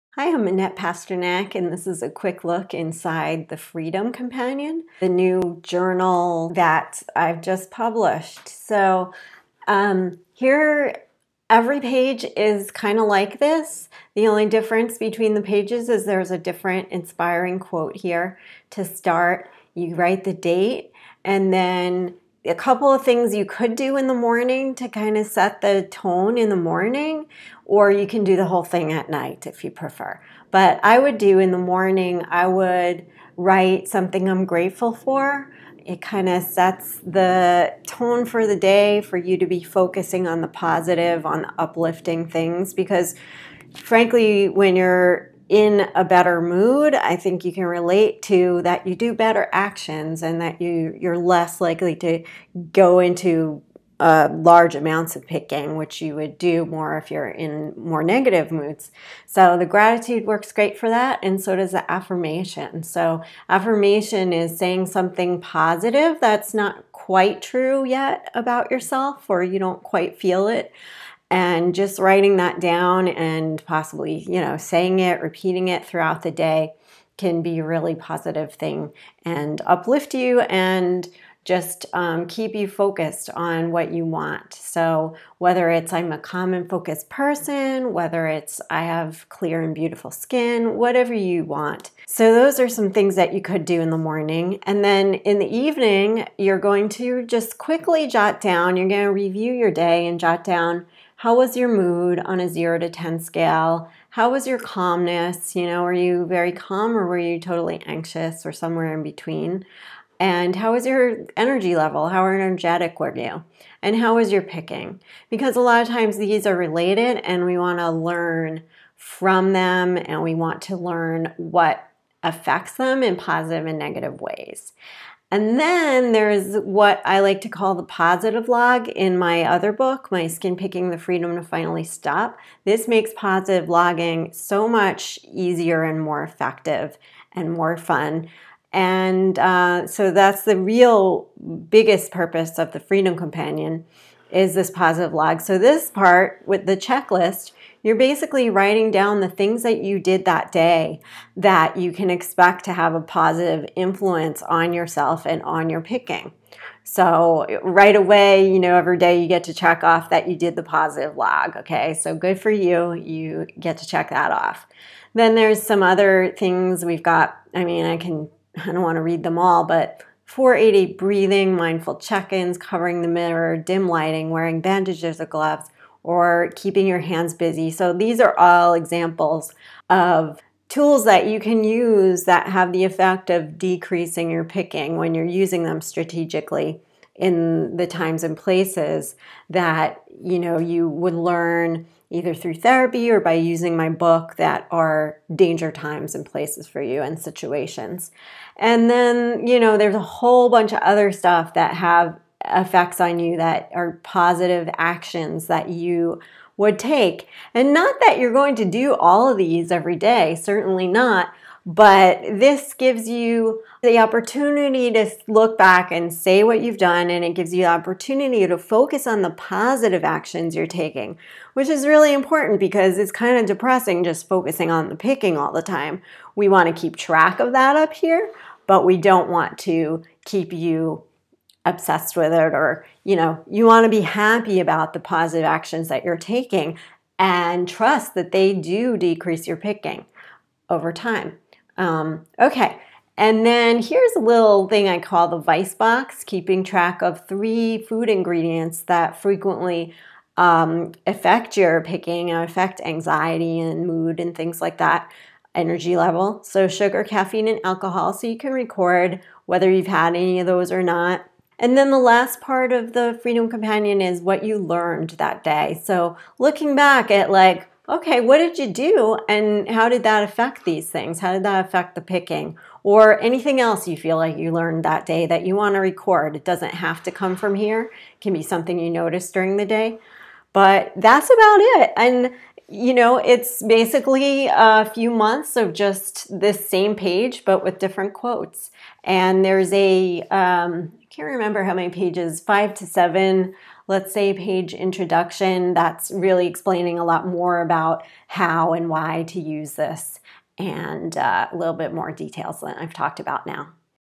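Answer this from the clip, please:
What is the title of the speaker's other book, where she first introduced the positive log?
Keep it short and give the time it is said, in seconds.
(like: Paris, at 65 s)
My Skin Picking the Freedom to Finally Stop, at 130 s.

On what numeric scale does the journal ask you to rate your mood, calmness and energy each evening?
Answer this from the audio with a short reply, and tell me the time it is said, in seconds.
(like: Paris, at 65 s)
0 to 10, at 102 s.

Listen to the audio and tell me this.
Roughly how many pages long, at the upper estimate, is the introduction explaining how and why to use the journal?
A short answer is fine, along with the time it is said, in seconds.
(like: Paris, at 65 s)
7, at 292 s.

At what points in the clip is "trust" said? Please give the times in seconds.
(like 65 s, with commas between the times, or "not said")
237 s.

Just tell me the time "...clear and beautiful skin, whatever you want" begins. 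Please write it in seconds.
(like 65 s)
89 s.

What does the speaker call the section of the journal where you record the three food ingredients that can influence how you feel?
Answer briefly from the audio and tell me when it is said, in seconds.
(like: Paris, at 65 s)
vice box, at 245 s.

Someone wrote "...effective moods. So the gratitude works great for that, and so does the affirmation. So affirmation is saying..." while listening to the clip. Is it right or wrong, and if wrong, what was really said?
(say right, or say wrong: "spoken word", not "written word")
wrong: "negative", not "effective".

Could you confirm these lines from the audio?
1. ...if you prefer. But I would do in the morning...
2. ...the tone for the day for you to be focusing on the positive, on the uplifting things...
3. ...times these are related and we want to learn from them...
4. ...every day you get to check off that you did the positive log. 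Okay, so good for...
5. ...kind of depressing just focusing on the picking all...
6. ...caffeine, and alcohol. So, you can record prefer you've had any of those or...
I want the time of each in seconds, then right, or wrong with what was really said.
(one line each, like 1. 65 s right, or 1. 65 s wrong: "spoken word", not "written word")
1. 29 s right
2. 36 s right
3. 115 s right
4. 158 s right
5. 223 s right
6. 257 s wrong: "whether", not "prefer".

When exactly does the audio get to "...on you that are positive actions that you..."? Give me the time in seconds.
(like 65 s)
202 s.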